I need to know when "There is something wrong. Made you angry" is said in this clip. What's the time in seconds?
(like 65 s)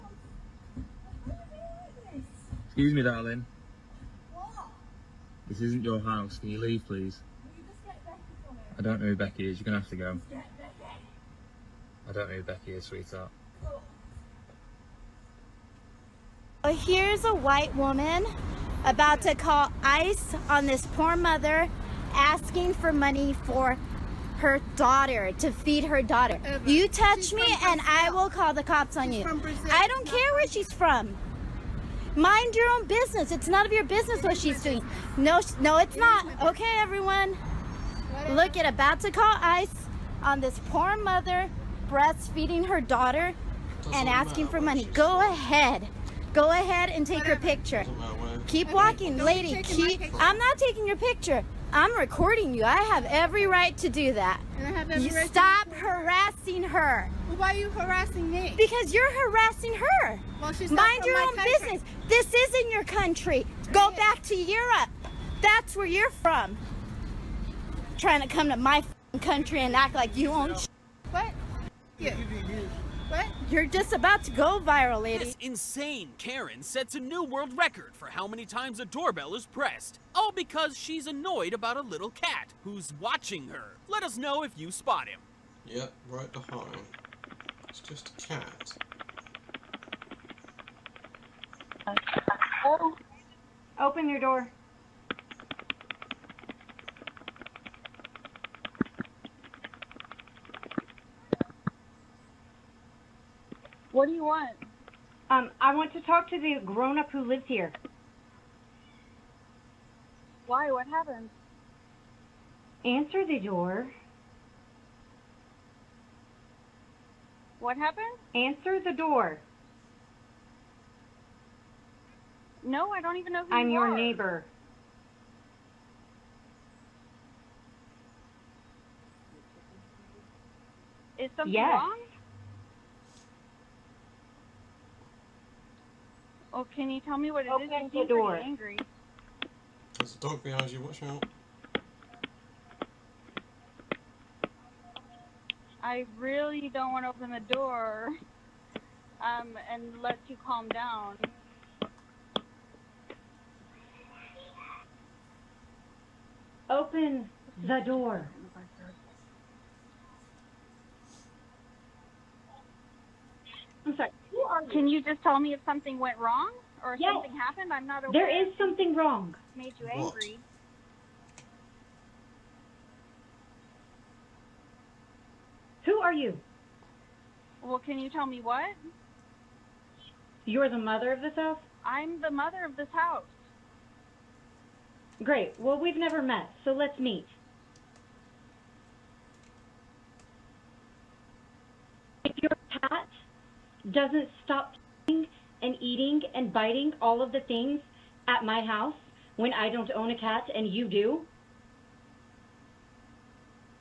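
168 s.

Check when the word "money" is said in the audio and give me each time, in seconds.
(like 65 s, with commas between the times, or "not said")
22 s, 44 s.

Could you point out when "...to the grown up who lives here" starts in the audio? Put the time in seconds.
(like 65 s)
106 s.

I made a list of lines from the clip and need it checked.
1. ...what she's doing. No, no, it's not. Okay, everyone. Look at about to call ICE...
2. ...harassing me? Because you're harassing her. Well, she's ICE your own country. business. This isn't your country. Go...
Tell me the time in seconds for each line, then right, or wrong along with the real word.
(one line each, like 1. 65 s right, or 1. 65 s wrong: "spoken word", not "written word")
1. 34 s right
2. 57 s wrong: "Mind", not "ICE".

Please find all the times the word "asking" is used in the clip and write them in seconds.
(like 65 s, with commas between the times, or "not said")
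22 s, 44 s.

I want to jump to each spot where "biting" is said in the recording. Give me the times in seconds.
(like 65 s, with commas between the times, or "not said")
196 s.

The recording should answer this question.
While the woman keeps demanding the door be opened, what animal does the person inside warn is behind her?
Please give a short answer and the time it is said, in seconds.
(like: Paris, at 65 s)
A dog, at 140 s.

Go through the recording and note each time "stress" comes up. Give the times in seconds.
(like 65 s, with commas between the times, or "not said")
not said.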